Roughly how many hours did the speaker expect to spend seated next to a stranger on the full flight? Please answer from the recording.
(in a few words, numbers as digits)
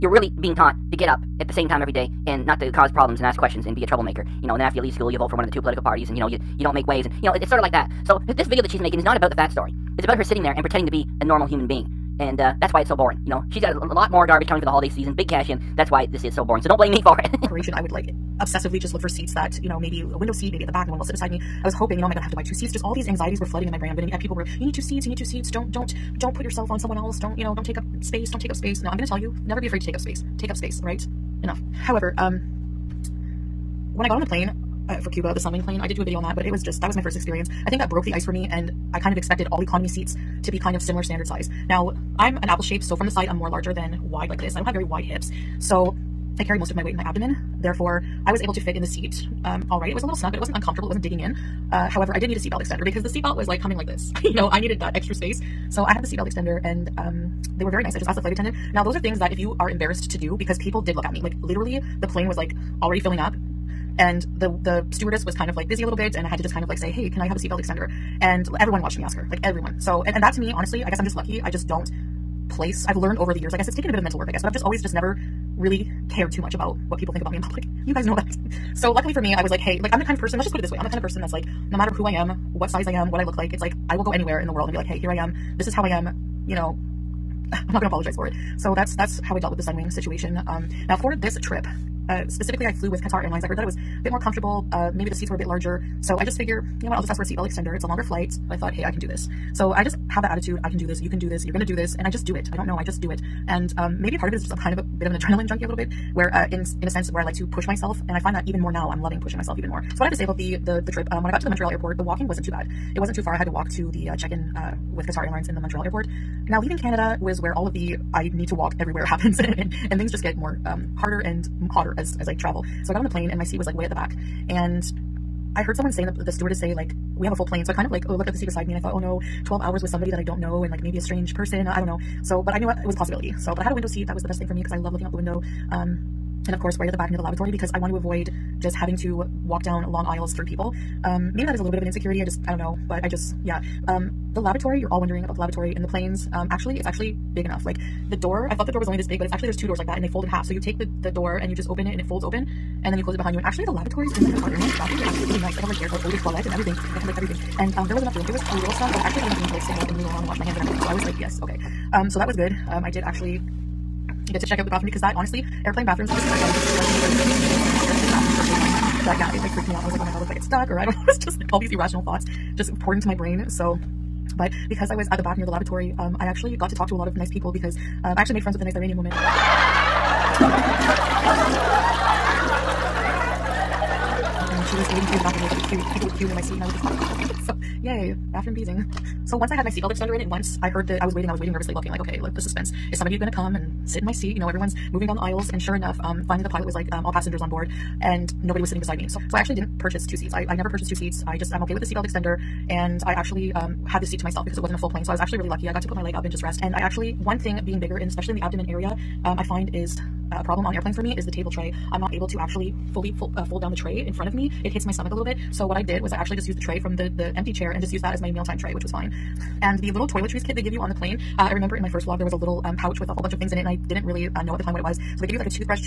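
12.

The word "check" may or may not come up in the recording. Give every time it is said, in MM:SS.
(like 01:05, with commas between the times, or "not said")
01:54, 02:44.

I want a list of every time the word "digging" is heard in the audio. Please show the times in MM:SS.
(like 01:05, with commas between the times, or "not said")
00:51.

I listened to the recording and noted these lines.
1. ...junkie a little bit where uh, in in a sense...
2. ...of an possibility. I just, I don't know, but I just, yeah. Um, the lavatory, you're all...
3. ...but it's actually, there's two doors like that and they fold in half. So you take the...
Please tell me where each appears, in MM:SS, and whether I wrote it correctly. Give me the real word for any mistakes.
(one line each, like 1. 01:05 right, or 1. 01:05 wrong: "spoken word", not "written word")
1. 01:45 right
2. 02:21 wrong: "insecurity", not "possibility"
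3. 02:29 right.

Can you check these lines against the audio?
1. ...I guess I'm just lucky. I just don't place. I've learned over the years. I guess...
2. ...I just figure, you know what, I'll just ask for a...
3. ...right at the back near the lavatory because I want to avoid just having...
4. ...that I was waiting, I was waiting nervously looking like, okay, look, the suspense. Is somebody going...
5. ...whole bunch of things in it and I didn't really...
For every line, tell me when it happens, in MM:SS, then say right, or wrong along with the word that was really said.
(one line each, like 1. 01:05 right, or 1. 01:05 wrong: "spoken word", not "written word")
1. 01:10 right
2. 01:36 right
3. 02:16 right
4. 03:10 right
5. 03:43 right.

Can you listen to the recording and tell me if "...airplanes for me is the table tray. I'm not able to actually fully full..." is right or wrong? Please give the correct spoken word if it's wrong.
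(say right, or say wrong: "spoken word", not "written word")
right.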